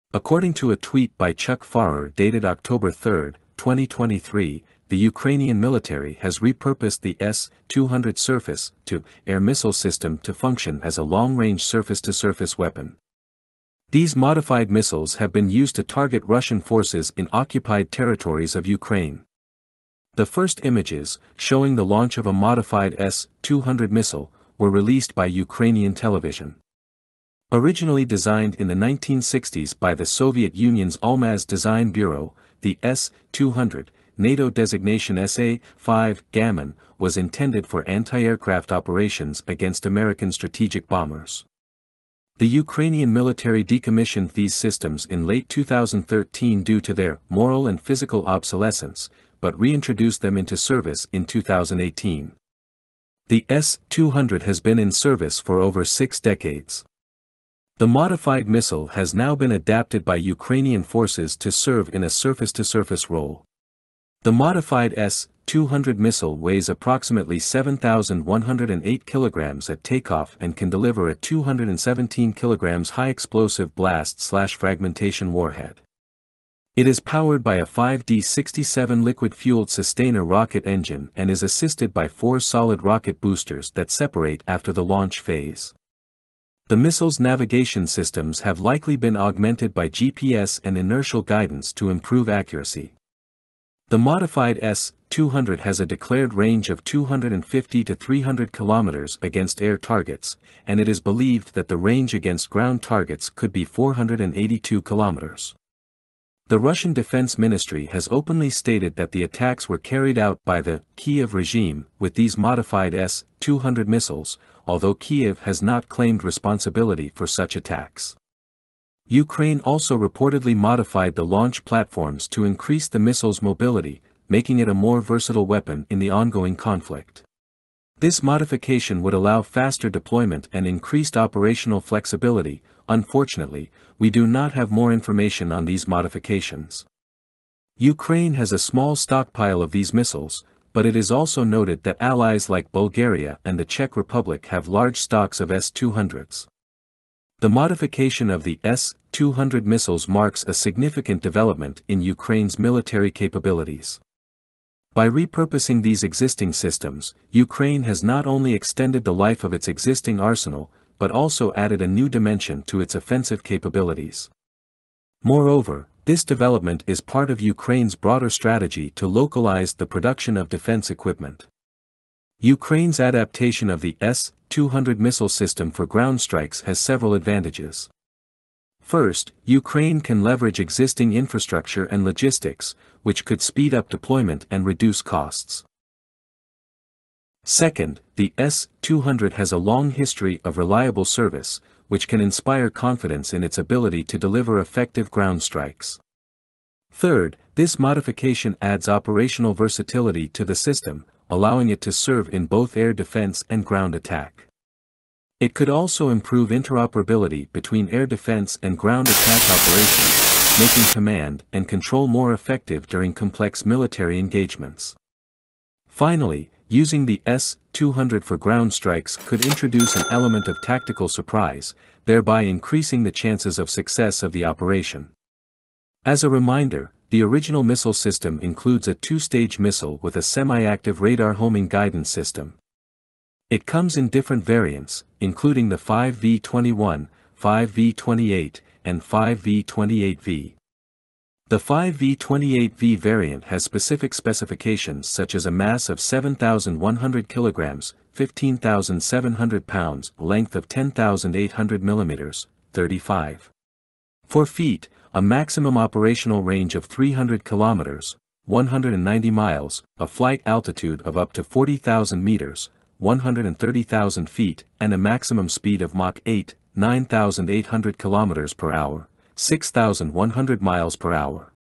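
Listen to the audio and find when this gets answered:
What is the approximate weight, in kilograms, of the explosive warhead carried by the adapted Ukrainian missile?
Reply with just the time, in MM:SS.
01:11.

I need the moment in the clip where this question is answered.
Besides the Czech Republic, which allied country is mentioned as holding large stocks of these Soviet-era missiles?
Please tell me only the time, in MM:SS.
02:22.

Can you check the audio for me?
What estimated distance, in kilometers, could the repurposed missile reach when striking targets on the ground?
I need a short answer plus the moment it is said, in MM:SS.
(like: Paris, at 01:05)
482 kilometers, at 01:43.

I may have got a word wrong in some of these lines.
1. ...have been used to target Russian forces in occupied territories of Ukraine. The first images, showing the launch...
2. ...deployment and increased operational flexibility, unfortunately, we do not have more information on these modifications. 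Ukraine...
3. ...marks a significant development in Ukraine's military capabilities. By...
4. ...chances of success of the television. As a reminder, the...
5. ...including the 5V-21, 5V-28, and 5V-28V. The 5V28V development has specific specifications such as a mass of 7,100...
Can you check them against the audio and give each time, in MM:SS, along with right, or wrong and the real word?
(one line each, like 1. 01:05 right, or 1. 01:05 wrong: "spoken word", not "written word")
1. 00:15 right
2. 02:09 right
3. 02:30 right
4. 03:43 wrong: "operation", not "television"
5. 03:55 wrong: "variant", not "development".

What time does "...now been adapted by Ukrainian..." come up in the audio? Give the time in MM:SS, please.
00:59.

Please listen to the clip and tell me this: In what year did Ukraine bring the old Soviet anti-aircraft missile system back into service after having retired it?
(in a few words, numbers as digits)
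2018.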